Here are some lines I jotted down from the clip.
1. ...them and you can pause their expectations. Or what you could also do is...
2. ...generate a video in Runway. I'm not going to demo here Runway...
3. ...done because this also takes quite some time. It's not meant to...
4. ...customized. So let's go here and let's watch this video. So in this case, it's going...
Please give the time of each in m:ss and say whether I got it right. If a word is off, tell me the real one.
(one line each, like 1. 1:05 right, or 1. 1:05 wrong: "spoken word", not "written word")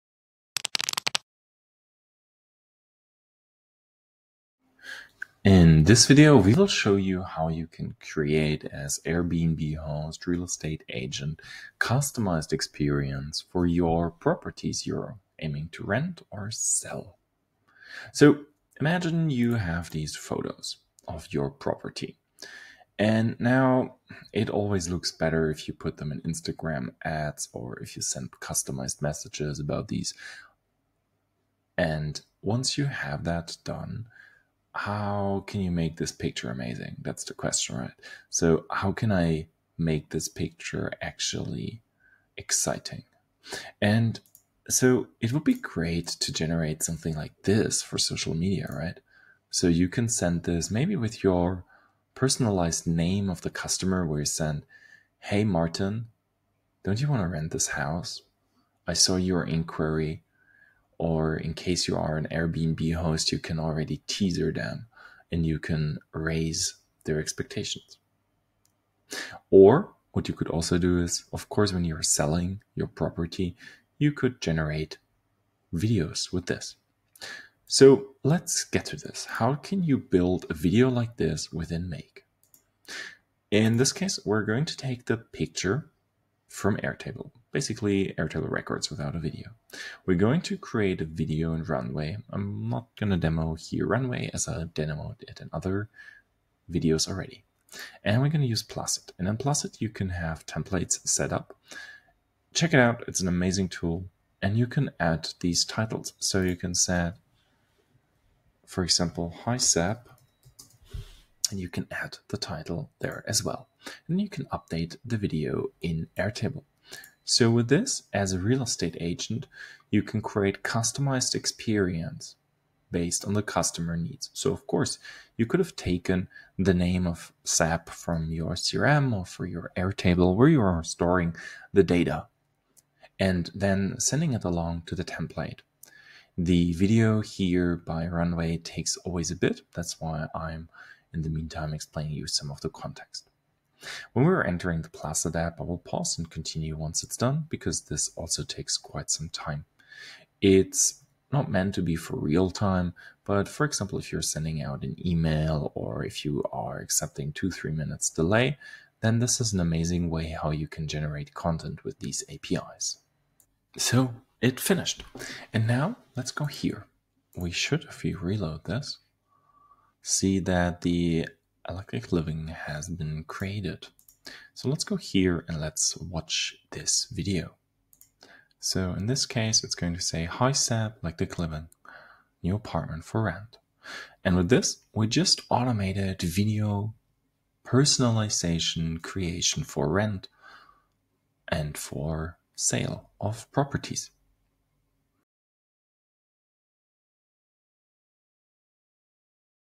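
1. 1:04 wrong: "raise", not "pause"
2. 1:30 wrong: "create", not "generate"
3. 2:27 right
4. 2:53 wrong: "created", not "customized".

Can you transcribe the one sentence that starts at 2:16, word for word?
The video here by Runway takes always a bit.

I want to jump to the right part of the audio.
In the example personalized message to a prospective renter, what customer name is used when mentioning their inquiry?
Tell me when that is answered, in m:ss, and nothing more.
0:55.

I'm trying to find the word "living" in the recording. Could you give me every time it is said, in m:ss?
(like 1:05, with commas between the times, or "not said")
2:52, 3:01.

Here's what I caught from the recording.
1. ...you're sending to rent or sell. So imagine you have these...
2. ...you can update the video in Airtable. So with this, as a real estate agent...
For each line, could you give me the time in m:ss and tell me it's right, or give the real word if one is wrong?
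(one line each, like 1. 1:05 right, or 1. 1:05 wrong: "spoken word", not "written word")
1. 0:14 wrong: "aiming", not "sending"
2. 1:54 right.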